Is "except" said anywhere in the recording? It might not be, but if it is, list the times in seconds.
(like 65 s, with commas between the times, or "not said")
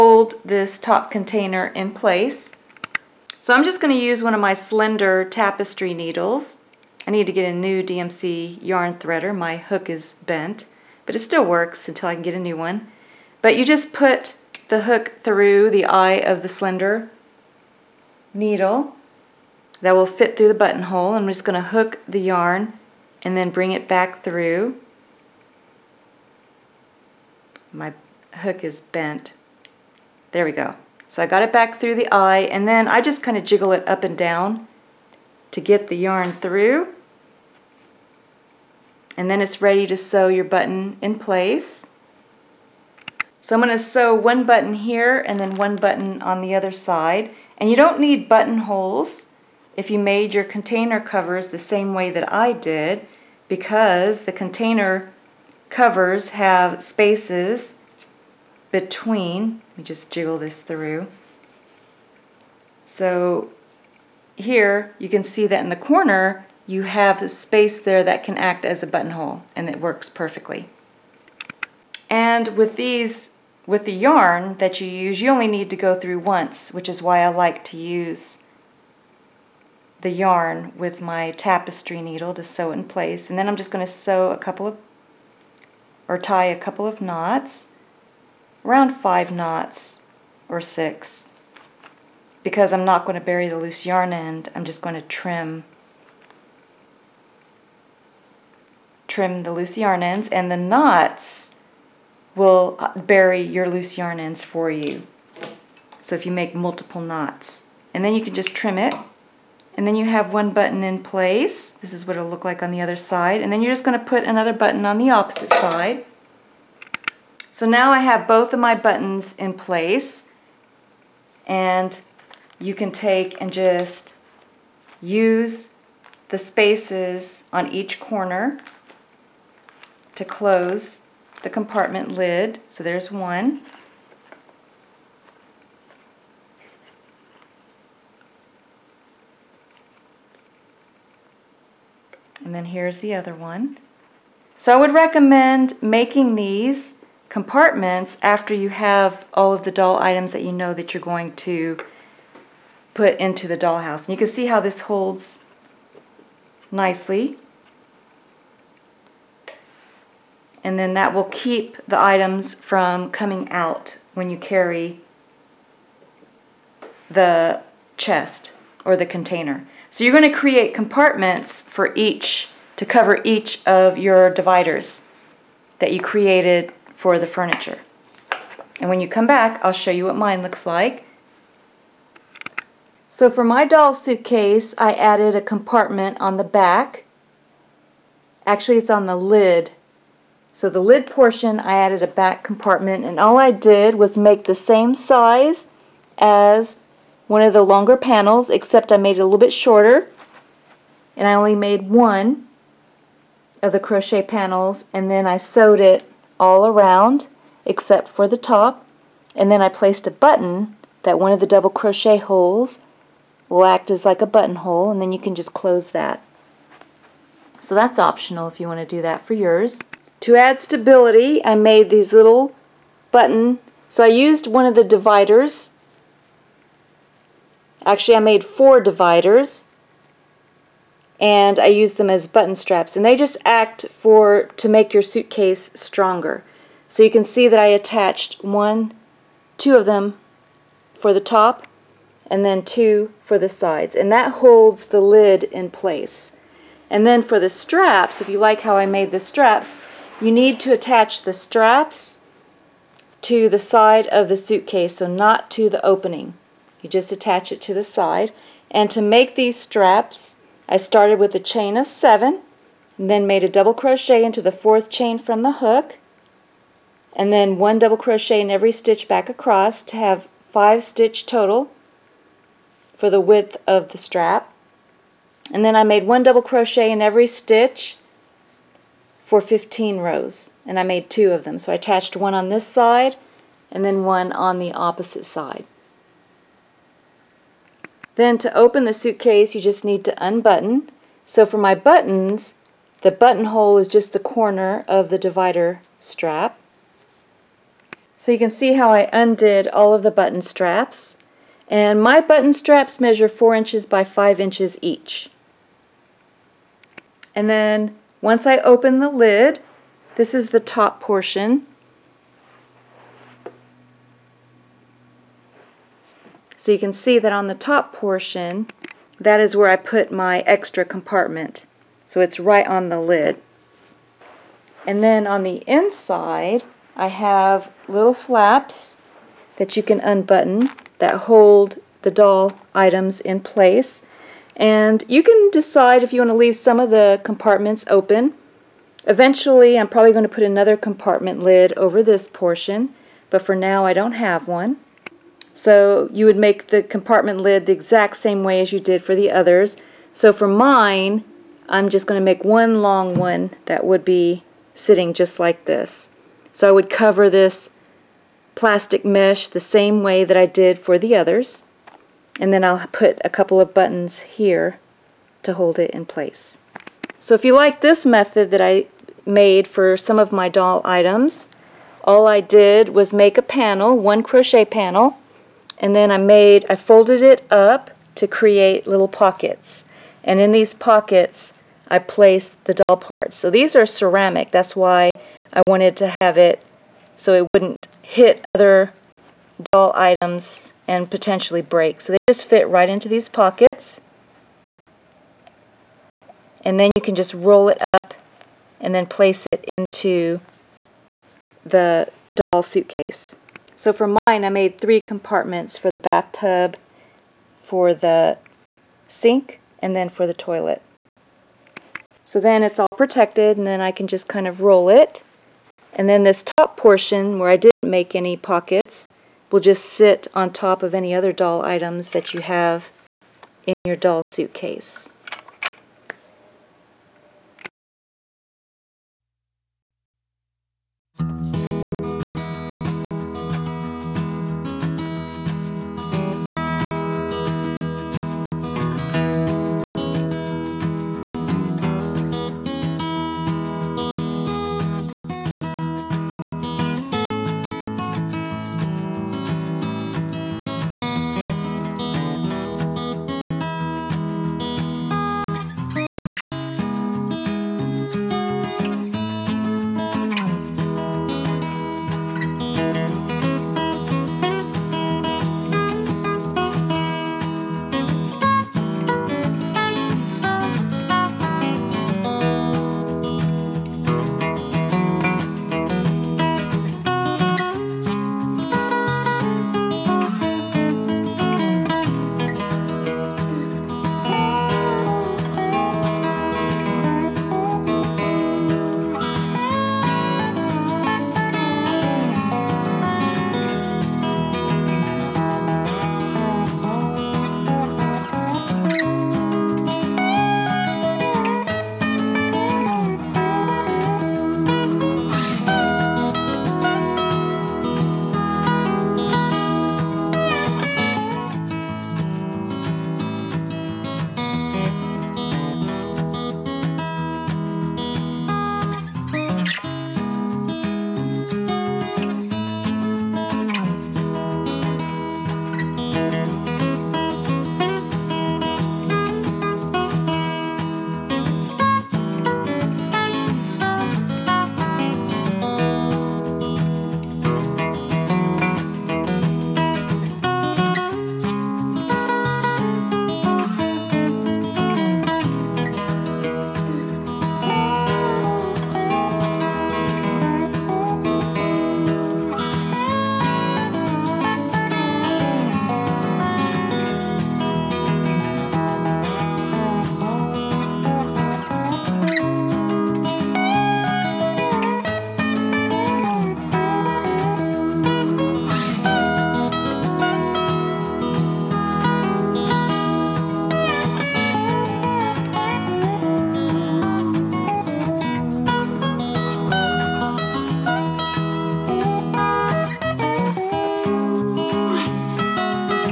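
198 s, 207 s.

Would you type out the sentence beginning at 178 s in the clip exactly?
And when you come back, I'll show you what mine looks like.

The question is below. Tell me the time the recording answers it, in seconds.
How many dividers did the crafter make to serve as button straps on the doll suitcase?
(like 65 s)
228 s.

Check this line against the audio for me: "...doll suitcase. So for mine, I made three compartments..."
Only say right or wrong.
right.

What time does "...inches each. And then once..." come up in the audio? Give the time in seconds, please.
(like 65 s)
304 s.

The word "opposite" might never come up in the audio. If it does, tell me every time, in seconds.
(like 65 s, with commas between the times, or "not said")
115 s, 284 s.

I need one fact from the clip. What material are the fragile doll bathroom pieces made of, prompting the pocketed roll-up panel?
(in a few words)
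ceramic.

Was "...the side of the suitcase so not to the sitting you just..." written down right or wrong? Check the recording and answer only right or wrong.
wrong.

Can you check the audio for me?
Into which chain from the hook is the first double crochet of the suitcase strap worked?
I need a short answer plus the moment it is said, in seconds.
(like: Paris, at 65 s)
fourth, at 264 s.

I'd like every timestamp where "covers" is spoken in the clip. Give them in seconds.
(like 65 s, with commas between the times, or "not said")
51 s, 55 s, 172 s, 356 s.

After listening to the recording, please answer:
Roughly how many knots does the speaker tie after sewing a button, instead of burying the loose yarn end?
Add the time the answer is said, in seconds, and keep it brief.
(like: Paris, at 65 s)
5 or 6, at 88 s.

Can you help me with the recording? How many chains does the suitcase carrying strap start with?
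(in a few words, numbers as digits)
7.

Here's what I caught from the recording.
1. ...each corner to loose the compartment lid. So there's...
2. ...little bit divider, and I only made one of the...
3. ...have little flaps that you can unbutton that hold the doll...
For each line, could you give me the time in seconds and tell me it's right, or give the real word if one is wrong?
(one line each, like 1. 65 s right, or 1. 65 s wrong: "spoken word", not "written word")
1. 127 s wrong: "close", not "loose"
2. 199 s wrong: "shorter", not "divider"
3. 327 s right.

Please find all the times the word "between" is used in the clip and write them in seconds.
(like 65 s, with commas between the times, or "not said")
58 s.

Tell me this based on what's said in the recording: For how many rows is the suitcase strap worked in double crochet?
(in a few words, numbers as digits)
15.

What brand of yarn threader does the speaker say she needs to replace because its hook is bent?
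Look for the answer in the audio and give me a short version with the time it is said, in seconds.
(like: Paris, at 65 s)
DMC, at 7 s.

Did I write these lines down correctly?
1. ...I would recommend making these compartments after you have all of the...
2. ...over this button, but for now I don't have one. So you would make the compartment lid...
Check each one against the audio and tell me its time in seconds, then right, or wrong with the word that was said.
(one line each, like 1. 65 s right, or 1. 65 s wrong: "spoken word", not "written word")
1. 144 s right
2. 341 s wrong: "portion", not "button".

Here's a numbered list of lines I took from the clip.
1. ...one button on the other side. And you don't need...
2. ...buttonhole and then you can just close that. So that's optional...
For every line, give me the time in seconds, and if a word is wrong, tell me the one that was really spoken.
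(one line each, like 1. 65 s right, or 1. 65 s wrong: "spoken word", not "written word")
1. 45 s right
2. 214 s right.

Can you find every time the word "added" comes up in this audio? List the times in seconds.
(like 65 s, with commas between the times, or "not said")
184 s, 191 s.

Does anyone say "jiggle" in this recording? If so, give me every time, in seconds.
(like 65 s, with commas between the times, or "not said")
33 s, 60 s.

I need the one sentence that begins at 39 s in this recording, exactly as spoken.
And then it's ready to sew your button in place.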